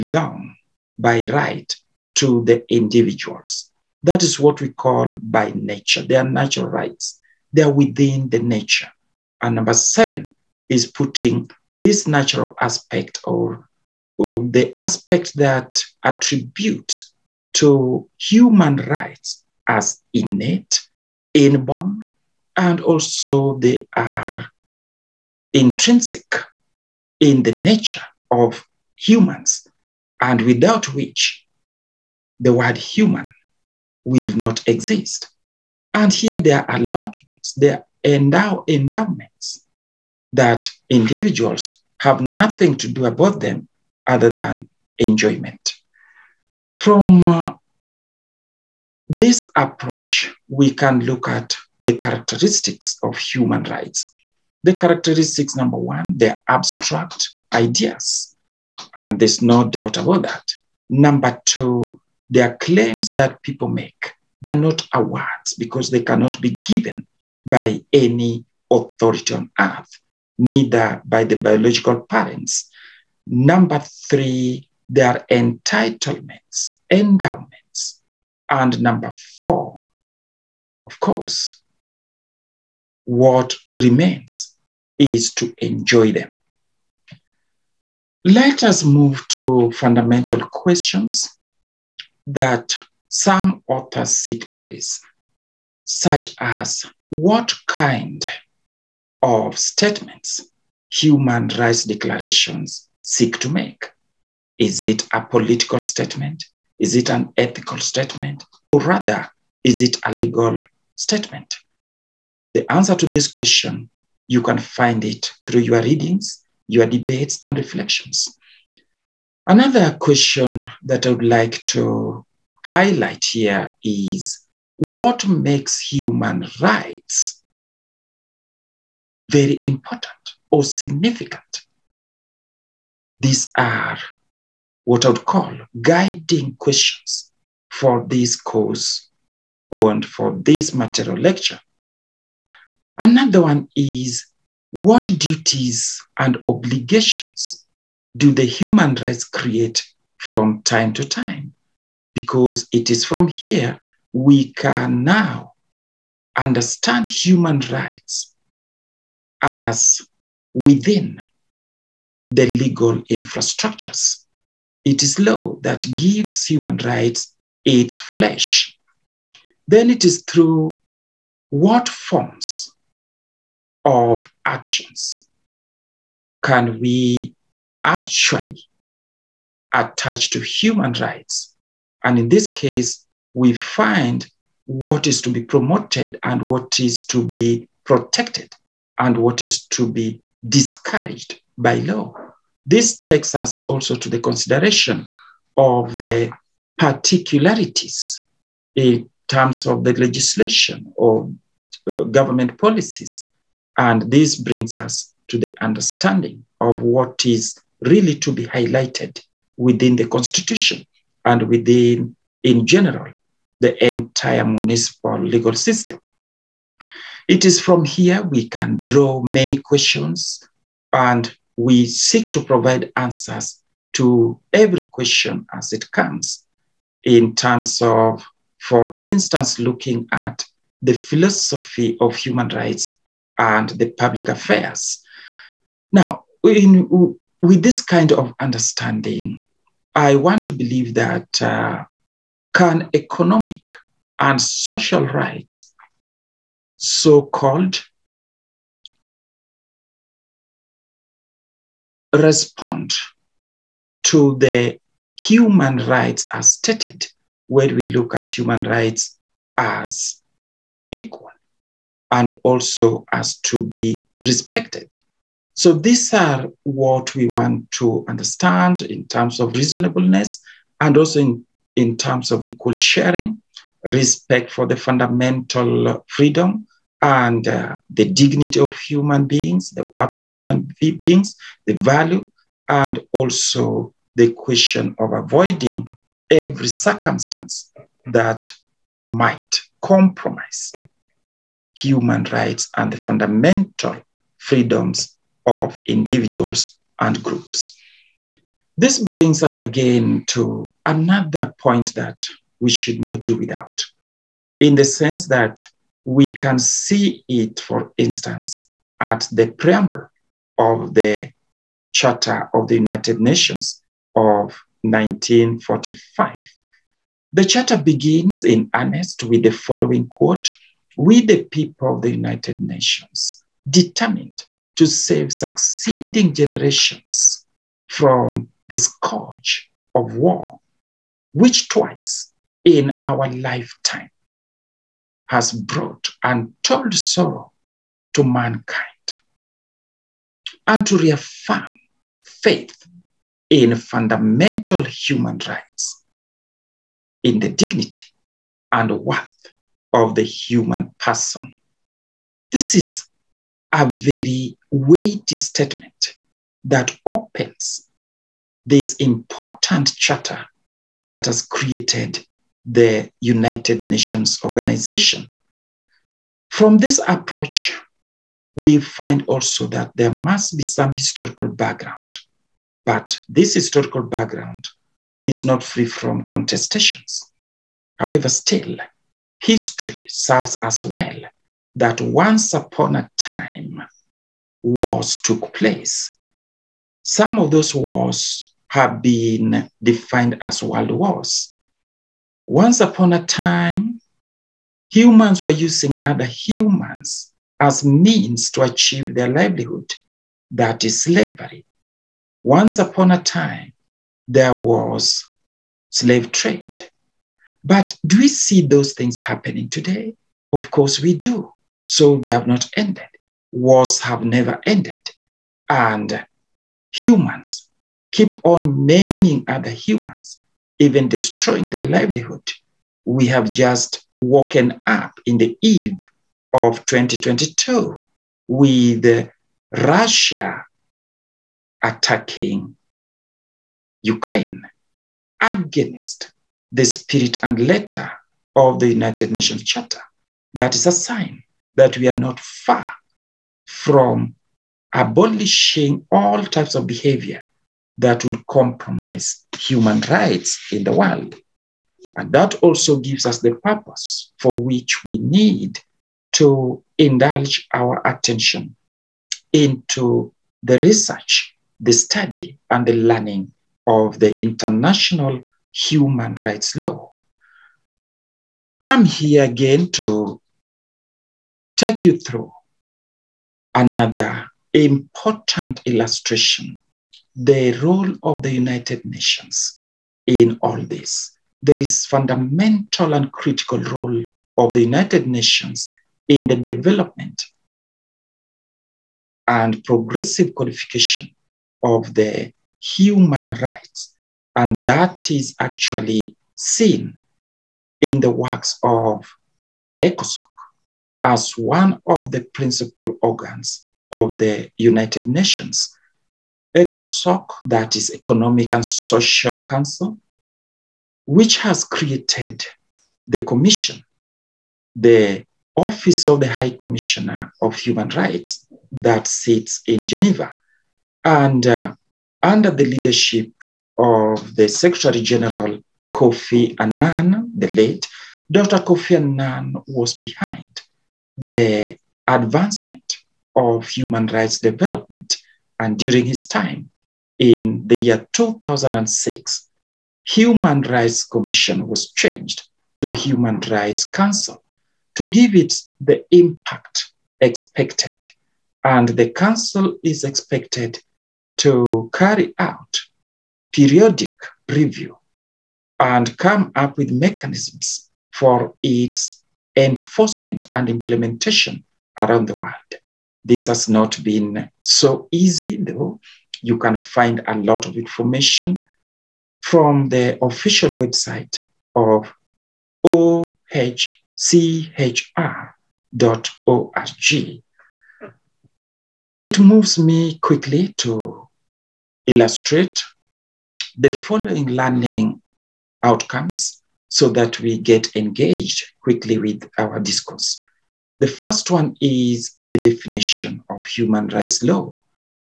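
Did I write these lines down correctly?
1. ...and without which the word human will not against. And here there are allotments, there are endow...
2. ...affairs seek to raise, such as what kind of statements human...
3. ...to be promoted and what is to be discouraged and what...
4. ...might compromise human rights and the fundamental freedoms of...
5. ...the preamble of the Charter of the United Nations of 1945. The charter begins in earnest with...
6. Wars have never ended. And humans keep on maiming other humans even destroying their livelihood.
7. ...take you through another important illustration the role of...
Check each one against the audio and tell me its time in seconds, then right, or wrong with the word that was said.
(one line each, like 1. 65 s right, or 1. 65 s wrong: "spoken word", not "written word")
1. 30 s wrong: "exist", not "against"
2. 93 s wrong: "authors", not "affairs"
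3. 185 s wrong: "protected", not "discouraged"
4. 289 s right
5. 309 s right
6. 413 s right
7. 471 s right.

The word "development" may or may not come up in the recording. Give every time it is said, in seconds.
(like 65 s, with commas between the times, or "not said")
486 s, 534 s.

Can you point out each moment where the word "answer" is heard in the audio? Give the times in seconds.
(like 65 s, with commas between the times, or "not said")
112 s, 222 s.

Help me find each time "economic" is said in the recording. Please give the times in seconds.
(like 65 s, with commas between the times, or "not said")
242 s, 508 s.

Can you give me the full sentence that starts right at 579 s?
It moves me quickly to illustrate the following learning outcomes so that we get engaged quickly with our discourse.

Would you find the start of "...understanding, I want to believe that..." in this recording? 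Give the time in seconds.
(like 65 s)
238 s.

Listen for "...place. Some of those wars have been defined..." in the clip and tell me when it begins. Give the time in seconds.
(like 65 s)
385 s.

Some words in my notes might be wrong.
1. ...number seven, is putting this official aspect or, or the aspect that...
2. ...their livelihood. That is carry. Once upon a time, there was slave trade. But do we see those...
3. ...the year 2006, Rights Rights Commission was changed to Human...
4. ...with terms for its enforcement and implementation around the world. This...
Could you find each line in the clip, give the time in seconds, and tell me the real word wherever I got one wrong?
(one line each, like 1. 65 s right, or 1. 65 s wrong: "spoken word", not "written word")
1. 9 s wrong: "natural", not "official"
2. 399 s wrong: "slavery", not "carry"
3. 537 s wrong: "Human", not "Rights"
4. 556 s wrong: "mechanisms", not "terms".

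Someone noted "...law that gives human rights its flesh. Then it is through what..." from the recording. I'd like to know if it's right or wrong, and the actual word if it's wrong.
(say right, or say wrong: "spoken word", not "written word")
right.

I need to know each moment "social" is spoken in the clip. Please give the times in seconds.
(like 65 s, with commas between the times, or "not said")
244 s, 508 s.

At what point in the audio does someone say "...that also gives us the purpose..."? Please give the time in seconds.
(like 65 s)
452 s.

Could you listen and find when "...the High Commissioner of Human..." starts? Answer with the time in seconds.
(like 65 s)
516 s.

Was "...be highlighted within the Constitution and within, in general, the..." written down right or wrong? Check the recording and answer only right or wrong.
right.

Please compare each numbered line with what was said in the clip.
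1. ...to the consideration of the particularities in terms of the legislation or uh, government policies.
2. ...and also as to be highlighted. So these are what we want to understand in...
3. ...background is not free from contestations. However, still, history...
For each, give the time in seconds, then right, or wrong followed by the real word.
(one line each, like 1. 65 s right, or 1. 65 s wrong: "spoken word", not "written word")
1. 193 s right
2. 262 s wrong: "respected", not "highlighted"
3. 374 s right.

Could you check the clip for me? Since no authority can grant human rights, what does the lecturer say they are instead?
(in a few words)
claims.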